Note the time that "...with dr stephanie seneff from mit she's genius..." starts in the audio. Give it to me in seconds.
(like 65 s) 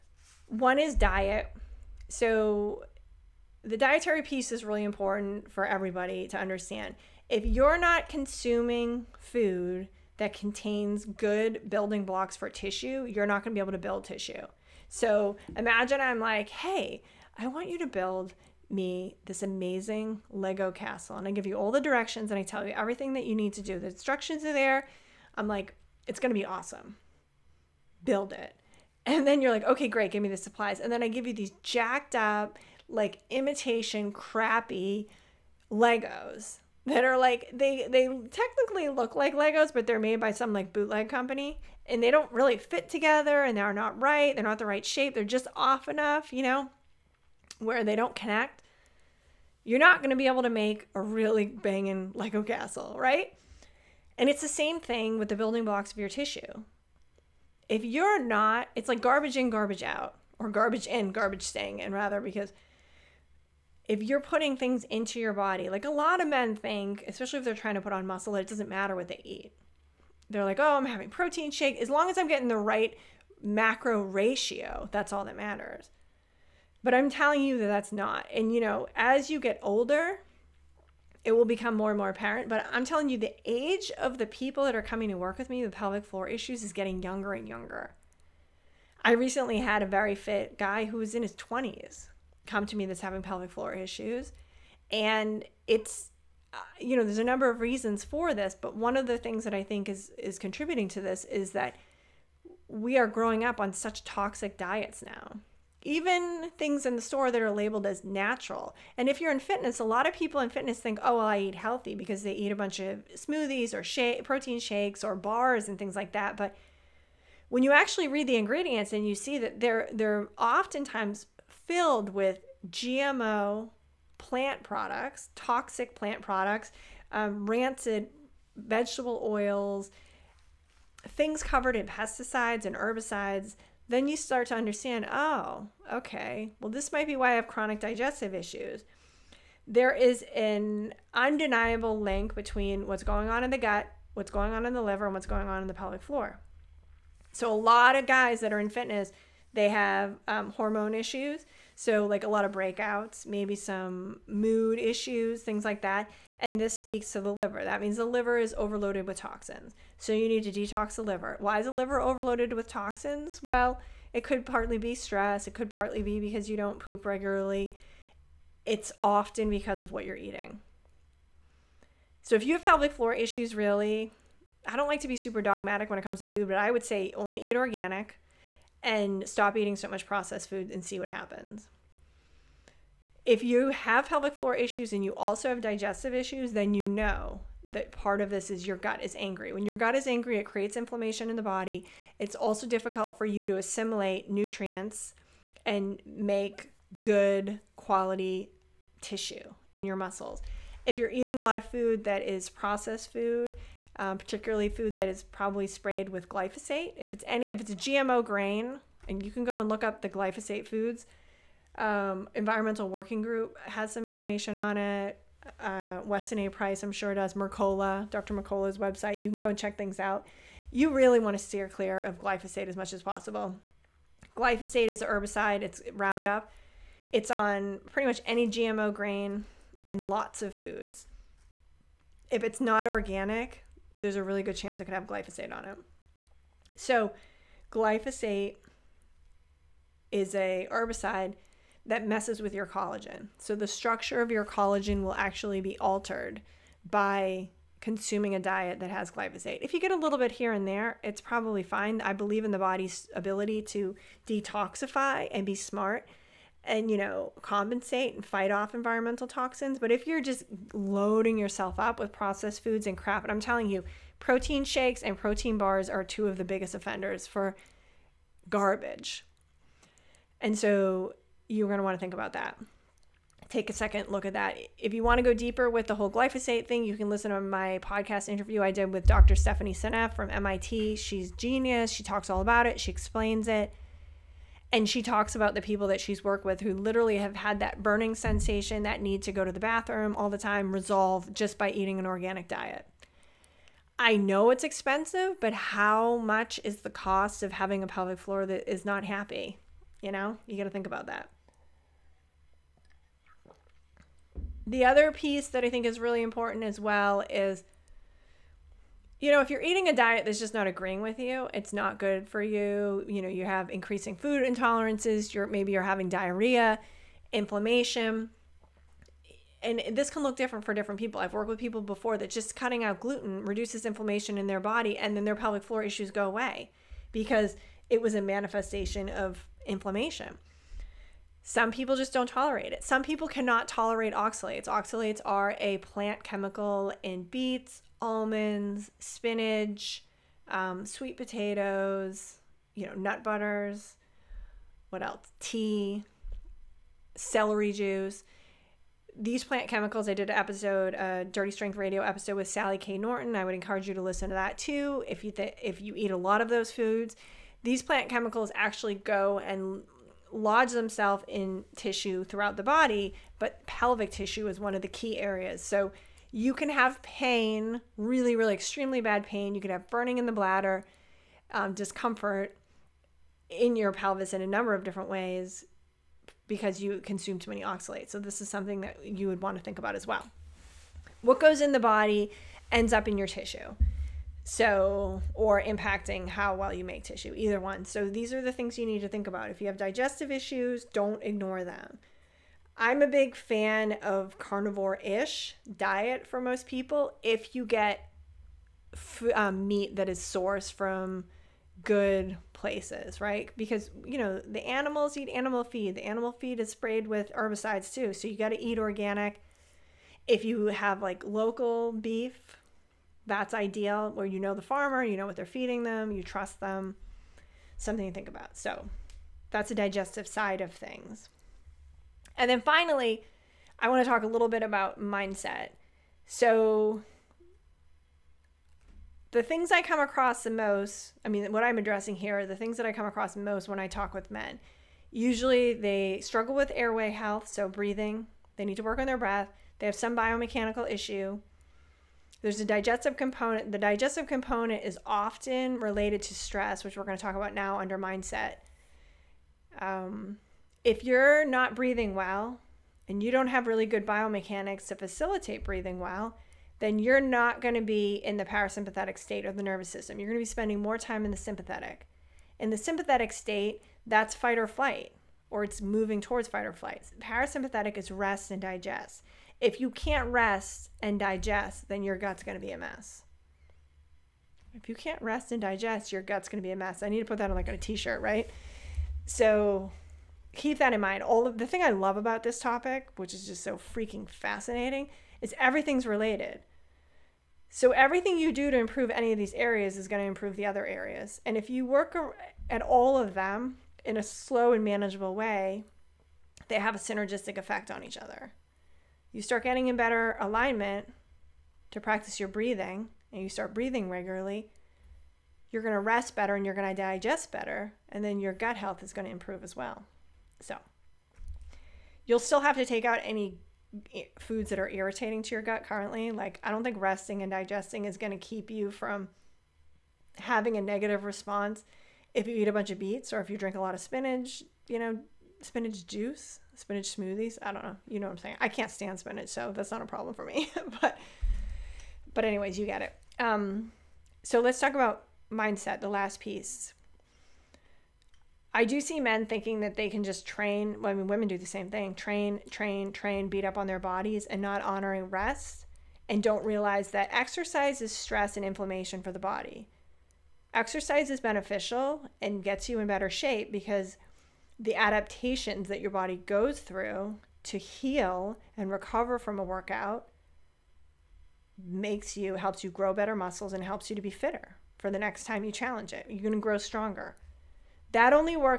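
278 s.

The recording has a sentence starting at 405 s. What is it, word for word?
The animal feed is sprayed with herbicides too.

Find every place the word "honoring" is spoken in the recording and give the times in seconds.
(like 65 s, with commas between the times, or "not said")
544 s.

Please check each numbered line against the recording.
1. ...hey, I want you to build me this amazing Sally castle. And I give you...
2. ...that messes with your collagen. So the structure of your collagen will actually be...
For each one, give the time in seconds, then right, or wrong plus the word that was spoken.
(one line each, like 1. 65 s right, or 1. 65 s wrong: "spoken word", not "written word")
1. 16 s wrong: "Lego", not "Sally"
2. 241 s right.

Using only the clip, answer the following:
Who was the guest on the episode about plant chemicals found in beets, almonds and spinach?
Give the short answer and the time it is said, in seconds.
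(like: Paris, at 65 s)
Sally K. Norton, at 352 s.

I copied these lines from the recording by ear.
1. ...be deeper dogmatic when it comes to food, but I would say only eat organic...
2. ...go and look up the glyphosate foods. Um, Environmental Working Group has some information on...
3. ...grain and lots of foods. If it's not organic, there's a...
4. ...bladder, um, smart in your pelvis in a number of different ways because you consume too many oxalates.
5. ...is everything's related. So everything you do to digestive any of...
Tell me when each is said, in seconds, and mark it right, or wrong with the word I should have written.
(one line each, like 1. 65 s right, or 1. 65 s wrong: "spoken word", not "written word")
1. 175 s wrong: "super", not "deeper"
2. 209 s right
3. 228 s right
4. 370 s wrong: "discomfort", not "smart"
5. 485 s wrong: "improve", not "digestive".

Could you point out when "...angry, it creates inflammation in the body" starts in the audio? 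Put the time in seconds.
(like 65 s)
190 s.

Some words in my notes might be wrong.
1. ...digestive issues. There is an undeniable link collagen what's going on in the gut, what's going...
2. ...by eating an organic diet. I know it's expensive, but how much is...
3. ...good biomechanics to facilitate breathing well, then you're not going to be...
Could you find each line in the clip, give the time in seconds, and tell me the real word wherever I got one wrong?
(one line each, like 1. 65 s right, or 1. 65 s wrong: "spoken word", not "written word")
1. 137 s wrong: "between", not "collagen"
2. 291 s right
3. 453 s right.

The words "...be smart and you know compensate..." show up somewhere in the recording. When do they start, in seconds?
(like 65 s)
255 s.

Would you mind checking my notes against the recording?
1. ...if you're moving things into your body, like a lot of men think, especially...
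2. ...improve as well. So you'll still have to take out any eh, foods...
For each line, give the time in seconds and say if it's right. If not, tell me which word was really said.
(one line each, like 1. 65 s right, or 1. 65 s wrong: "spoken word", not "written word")
1. 63 s wrong: "putting", not "moving"
2. 509 s right.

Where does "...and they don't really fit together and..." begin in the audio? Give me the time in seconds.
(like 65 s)
41 s.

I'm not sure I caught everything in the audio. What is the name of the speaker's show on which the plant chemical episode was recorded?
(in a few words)
Dirty Strength Radio.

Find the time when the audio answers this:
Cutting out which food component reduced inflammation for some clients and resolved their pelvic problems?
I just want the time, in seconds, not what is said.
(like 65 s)
322 s.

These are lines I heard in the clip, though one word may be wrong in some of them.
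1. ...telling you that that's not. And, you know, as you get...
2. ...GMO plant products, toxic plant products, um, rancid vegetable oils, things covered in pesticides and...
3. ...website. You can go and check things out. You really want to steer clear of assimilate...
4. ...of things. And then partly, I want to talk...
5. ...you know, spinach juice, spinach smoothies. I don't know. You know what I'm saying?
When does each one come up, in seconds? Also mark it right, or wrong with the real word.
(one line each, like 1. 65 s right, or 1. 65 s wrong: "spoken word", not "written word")
1. 77 s right
2. 122 s right
3. 218 s wrong: "glyphosate", not "assimilate"
4. 420 s wrong: "finally", not "partly"
5. 524 s right.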